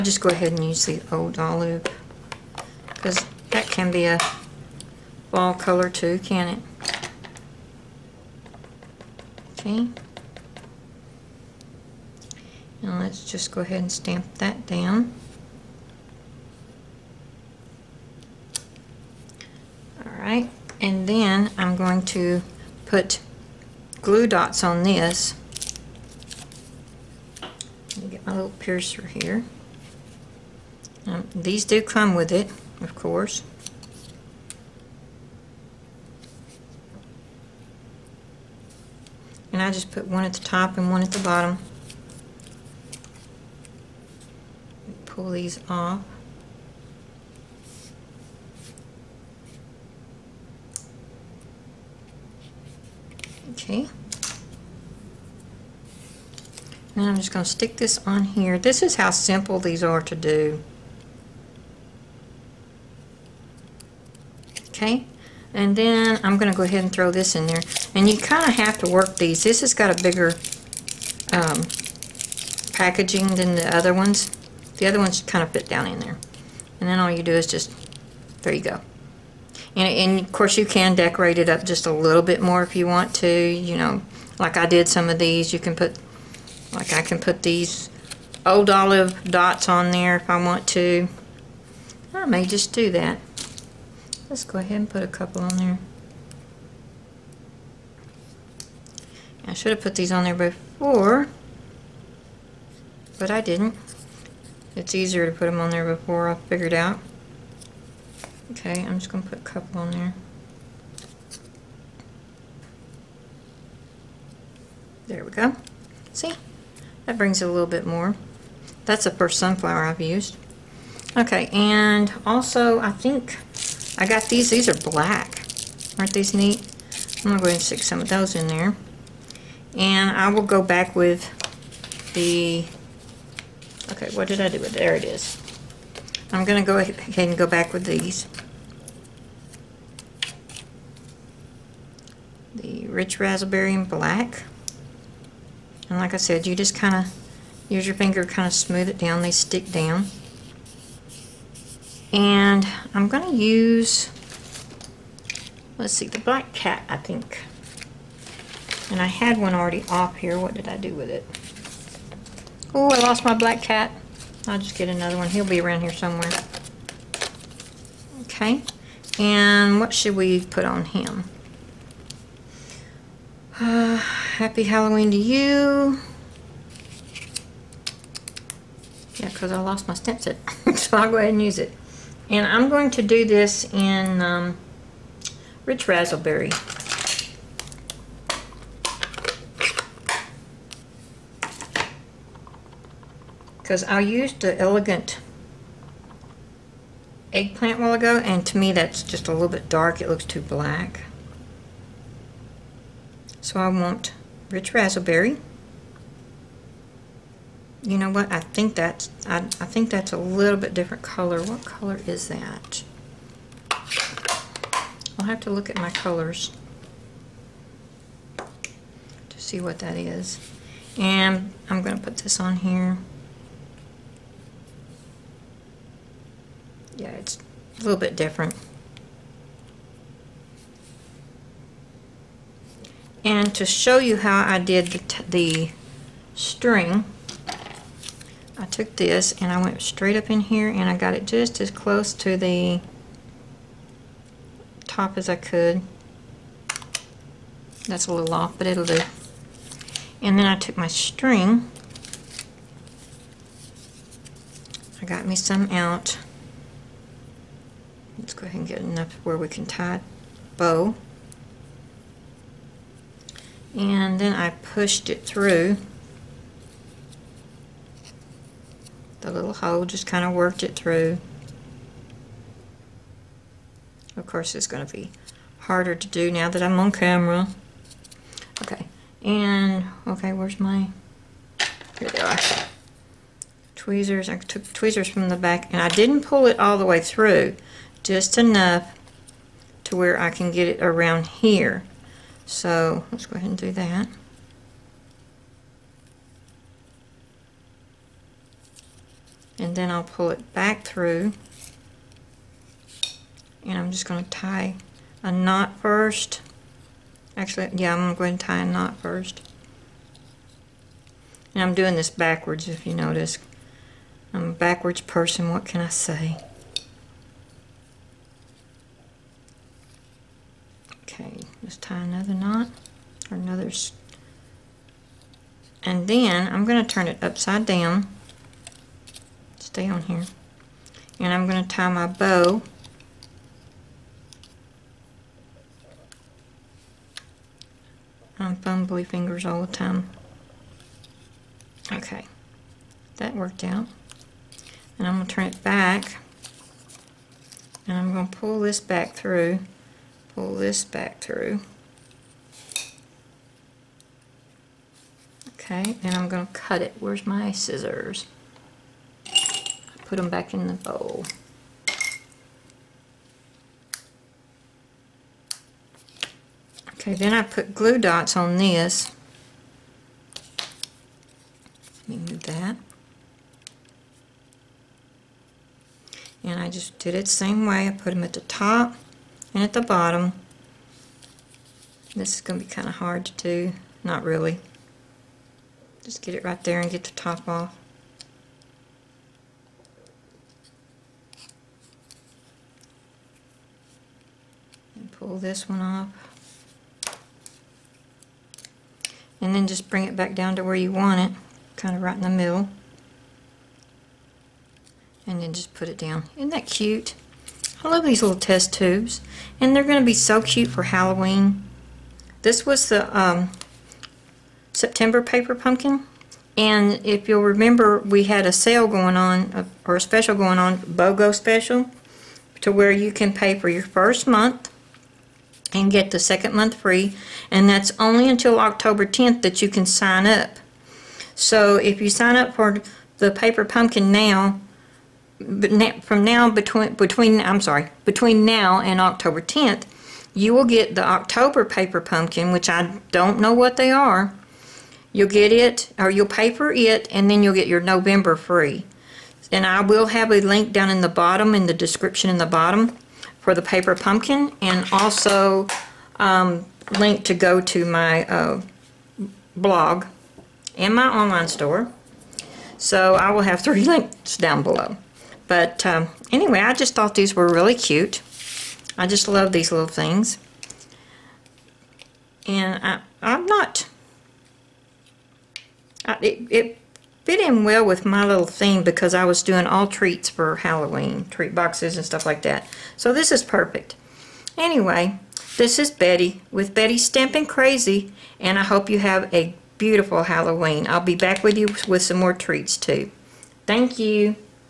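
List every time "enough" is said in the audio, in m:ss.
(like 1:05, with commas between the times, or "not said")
4:18, 4:48.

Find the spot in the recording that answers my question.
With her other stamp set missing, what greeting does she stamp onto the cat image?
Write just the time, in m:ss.
2:54.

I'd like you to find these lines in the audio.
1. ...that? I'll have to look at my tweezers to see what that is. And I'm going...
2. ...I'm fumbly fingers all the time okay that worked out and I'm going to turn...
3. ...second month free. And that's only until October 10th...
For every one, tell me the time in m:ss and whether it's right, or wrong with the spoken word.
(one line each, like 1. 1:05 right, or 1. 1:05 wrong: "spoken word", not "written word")
1. 3:32 wrong: "colors", not "tweezers"
2. 5:38 right
3. 7:06 right.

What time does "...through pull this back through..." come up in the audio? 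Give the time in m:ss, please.
5:49.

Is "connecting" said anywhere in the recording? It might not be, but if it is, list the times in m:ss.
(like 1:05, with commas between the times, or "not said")
not said.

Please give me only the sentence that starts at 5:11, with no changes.
And I'm doing this backwards if you notice.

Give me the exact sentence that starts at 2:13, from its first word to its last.
Okay, what did I do with There it is.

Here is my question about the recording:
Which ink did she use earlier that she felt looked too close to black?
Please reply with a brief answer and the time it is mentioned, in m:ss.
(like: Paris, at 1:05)
Elegant Eggplant, at 3:14.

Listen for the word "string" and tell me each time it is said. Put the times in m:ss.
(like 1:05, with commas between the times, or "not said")
3:56, 4:10.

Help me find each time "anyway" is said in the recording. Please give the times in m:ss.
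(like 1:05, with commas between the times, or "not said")
7:46, 8:04.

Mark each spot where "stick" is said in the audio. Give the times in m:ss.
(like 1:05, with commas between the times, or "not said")
0:57, 2:07, 2:29.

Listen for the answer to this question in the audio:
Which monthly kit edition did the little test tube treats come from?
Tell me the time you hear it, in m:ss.
6:54.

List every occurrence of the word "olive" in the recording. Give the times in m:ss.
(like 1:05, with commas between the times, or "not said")
0:01, 1:28.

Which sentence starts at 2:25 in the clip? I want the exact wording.
And like I said, you just kind of use your finger kind of smooth it down.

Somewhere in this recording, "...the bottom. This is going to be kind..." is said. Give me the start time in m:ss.
6:19.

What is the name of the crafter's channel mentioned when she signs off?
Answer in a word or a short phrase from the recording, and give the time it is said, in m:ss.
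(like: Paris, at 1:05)
Betty Stampin' Crazy, at 8:06.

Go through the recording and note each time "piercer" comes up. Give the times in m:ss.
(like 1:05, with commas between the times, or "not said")
0:28.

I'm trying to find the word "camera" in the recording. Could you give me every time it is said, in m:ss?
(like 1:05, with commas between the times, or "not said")
4:36.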